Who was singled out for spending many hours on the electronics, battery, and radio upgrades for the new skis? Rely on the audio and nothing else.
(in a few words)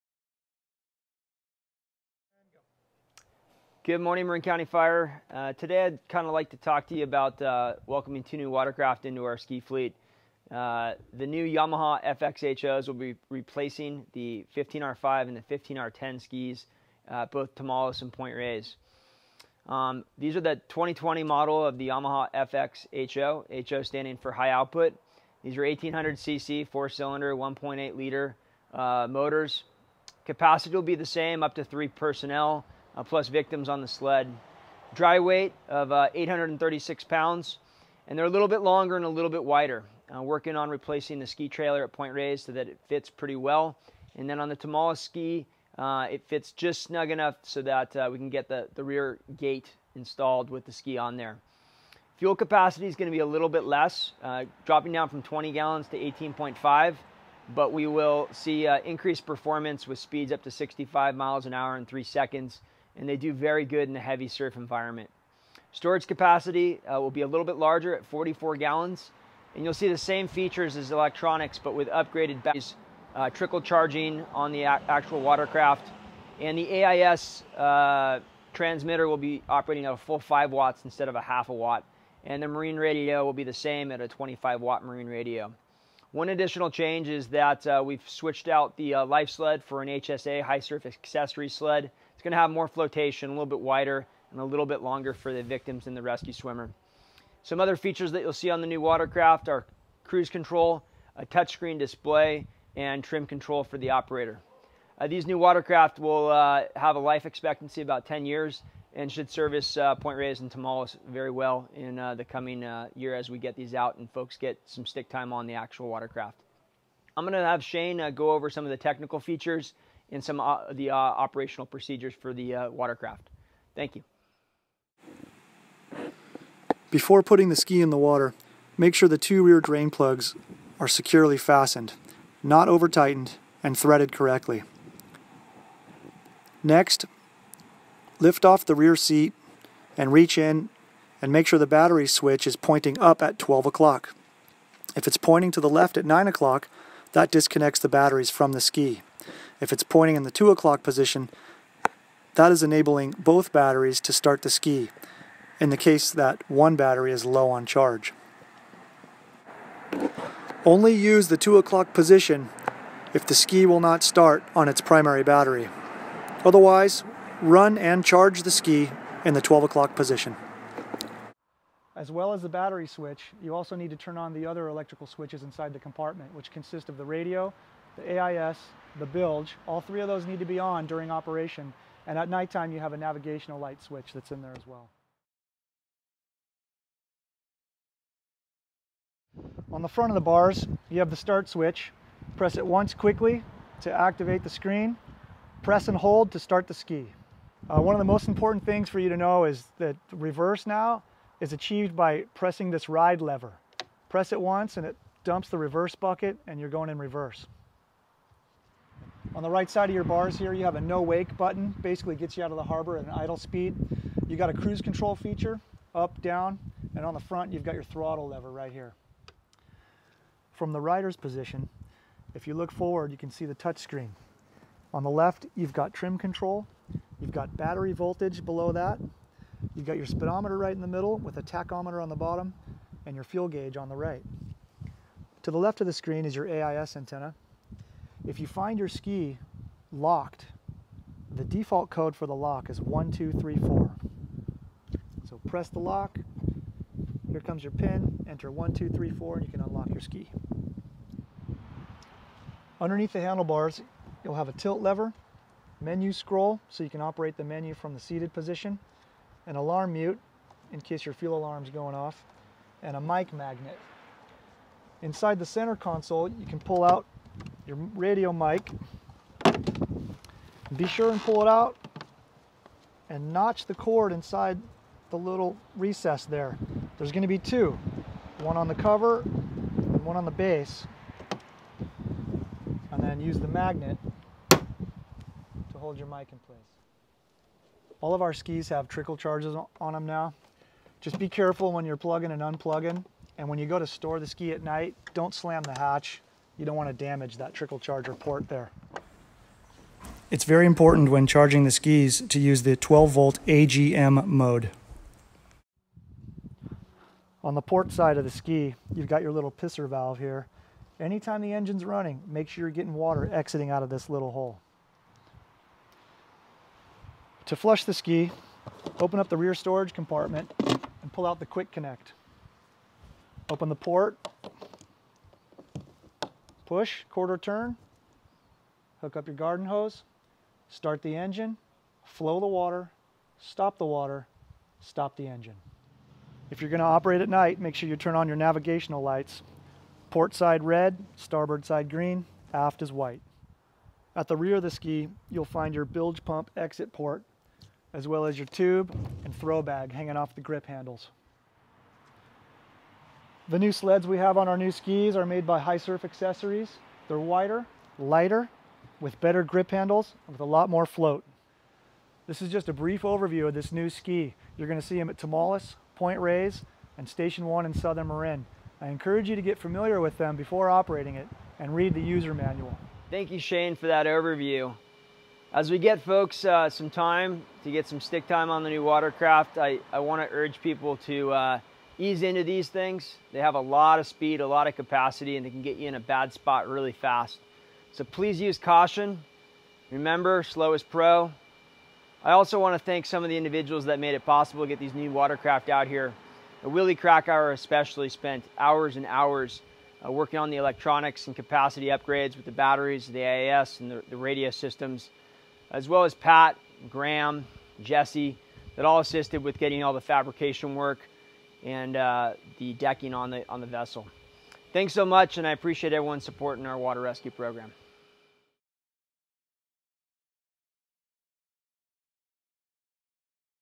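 Willie Krakauer.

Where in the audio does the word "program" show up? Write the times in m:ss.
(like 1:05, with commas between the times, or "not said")
6:57.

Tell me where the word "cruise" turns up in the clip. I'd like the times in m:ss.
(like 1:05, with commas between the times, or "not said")
1:40, 3:34.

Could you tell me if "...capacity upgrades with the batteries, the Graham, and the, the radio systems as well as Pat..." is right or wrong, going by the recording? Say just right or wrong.
wrong.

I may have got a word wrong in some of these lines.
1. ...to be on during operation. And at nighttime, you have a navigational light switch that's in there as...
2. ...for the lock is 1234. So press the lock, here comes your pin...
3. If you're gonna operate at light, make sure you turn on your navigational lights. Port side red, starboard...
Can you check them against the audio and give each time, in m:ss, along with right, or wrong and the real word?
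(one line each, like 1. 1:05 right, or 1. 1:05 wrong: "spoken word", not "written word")
1. 3:00 right
2. 4:02 right
3. 5:36 wrong: "night", not "light".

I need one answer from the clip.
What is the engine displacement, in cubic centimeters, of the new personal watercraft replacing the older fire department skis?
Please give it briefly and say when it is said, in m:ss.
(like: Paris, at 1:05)
1800cc, at 0:25.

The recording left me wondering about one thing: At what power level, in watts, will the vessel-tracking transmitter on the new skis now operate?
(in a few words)
5 watts.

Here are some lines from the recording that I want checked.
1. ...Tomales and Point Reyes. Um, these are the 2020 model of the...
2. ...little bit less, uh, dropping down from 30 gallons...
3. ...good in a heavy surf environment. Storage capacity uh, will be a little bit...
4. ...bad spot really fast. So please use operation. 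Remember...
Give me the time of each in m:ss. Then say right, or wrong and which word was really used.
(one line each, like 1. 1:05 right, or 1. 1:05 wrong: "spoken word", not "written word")
1. 0:17 right
2. 0:53 wrong: "20", not "30"
3. 1:03 right
4. 6:25 wrong: "caution", not "operation".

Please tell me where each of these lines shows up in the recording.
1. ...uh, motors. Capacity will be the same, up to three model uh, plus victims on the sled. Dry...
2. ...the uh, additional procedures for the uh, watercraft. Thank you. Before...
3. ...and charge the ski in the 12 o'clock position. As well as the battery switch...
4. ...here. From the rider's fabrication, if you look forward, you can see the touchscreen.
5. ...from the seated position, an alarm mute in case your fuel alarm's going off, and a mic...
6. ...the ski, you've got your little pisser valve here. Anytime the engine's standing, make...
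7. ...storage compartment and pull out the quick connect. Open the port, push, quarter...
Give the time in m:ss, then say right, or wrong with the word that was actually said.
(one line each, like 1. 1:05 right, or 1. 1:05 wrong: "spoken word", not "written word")
1. 0:28 wrong: "personnel", not "model"
2. 2:00 wrong: "operational", not "additional"
3. 2:47 right
4. 3:38 wrong: "position", not "fabrication"
5. 4:17 right
6. 5:08 wrong: "running", not "standing"
7. 5:19 right.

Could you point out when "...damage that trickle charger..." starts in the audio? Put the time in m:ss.
4:56.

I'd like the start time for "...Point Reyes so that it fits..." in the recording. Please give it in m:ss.
0:41.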